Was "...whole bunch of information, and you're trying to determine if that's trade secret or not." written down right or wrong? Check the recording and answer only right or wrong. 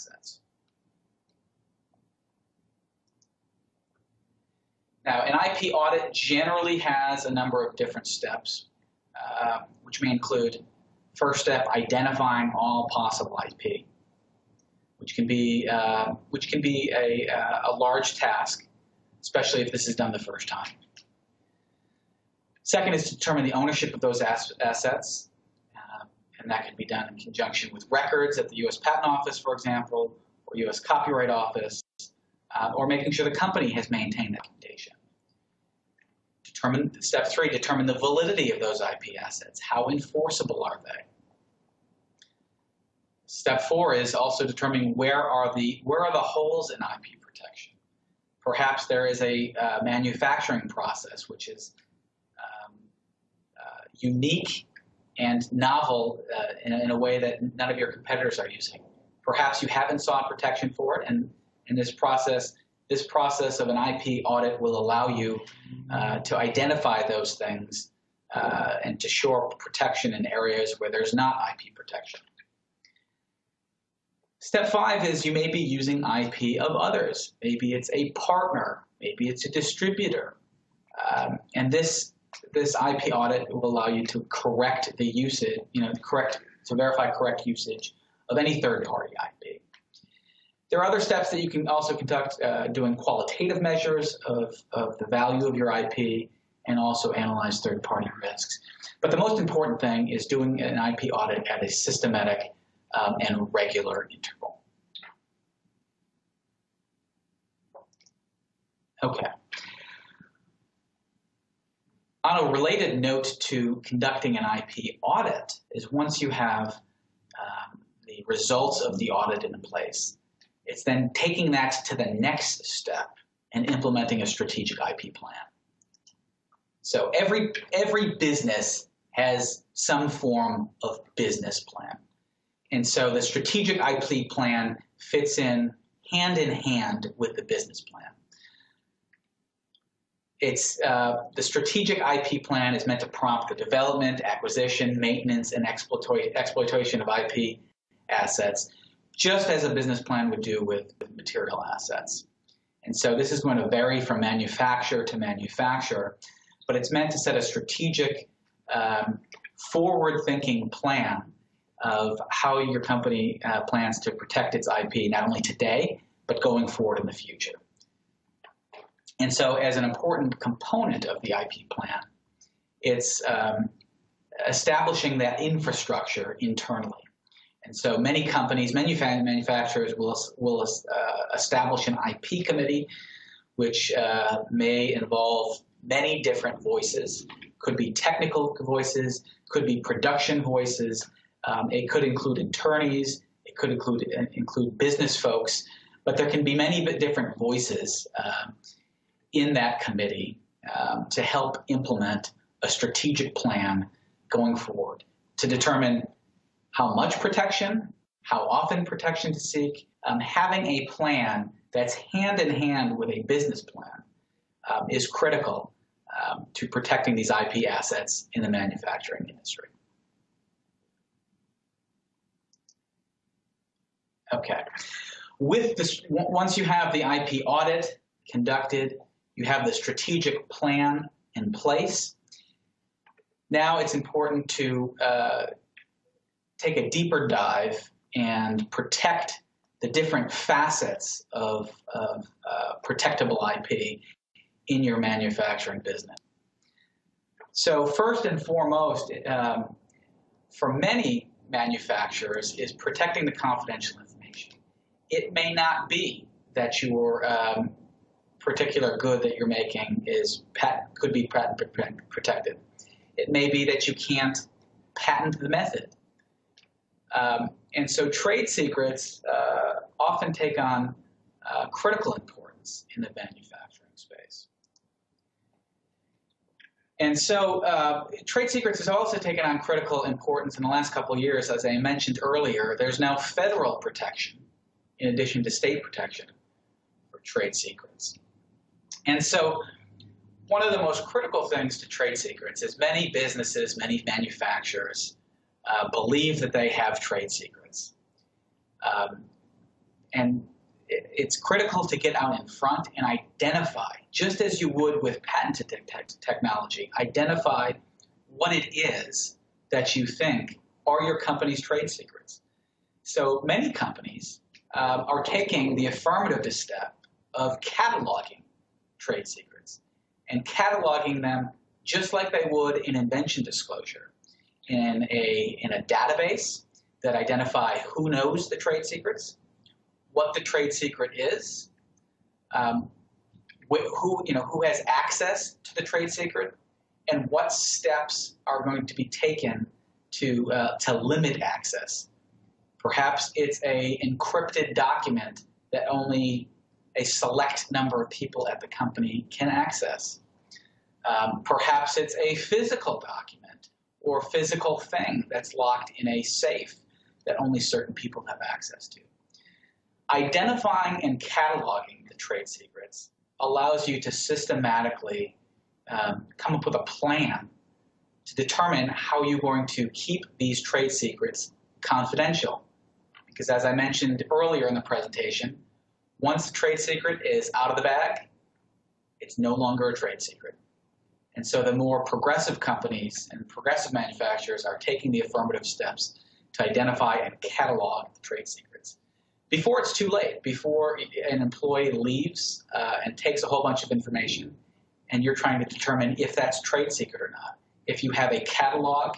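right.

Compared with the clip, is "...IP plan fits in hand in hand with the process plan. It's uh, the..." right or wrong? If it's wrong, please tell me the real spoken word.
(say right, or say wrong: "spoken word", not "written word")
wrong: "business", not "process".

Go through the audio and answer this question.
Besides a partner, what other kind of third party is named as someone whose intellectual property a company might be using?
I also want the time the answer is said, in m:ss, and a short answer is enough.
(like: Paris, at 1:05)
A distributor, at 1:19.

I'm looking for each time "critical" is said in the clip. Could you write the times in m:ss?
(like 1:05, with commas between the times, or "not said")
3:35, 4:31, 4:39, 4:51, 5:01.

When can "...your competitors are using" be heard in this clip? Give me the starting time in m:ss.
0:57.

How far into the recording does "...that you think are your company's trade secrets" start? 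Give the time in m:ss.
5:09.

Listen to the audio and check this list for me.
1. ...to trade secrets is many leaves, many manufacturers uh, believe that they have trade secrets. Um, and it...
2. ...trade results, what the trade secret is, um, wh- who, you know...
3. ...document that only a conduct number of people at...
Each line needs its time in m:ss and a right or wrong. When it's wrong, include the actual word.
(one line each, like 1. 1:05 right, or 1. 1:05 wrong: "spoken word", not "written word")
1. 4:51 wrong: "businesses", not "leaves"
2. 5:28 wrong: "secrets", not "results"
3. 5:44 wrong: "select", not "conduct".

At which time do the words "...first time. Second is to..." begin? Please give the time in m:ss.
0:20.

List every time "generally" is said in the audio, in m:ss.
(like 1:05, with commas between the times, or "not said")
0:06.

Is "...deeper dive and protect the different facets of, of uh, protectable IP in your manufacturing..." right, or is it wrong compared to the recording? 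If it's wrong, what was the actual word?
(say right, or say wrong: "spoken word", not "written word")
right.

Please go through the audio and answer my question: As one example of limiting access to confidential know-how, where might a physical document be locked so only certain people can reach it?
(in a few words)
A safe.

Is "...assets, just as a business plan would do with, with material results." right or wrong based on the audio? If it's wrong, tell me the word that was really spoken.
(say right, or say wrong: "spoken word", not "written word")
wrong: "assets", not "results".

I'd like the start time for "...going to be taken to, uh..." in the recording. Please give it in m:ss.
5:38.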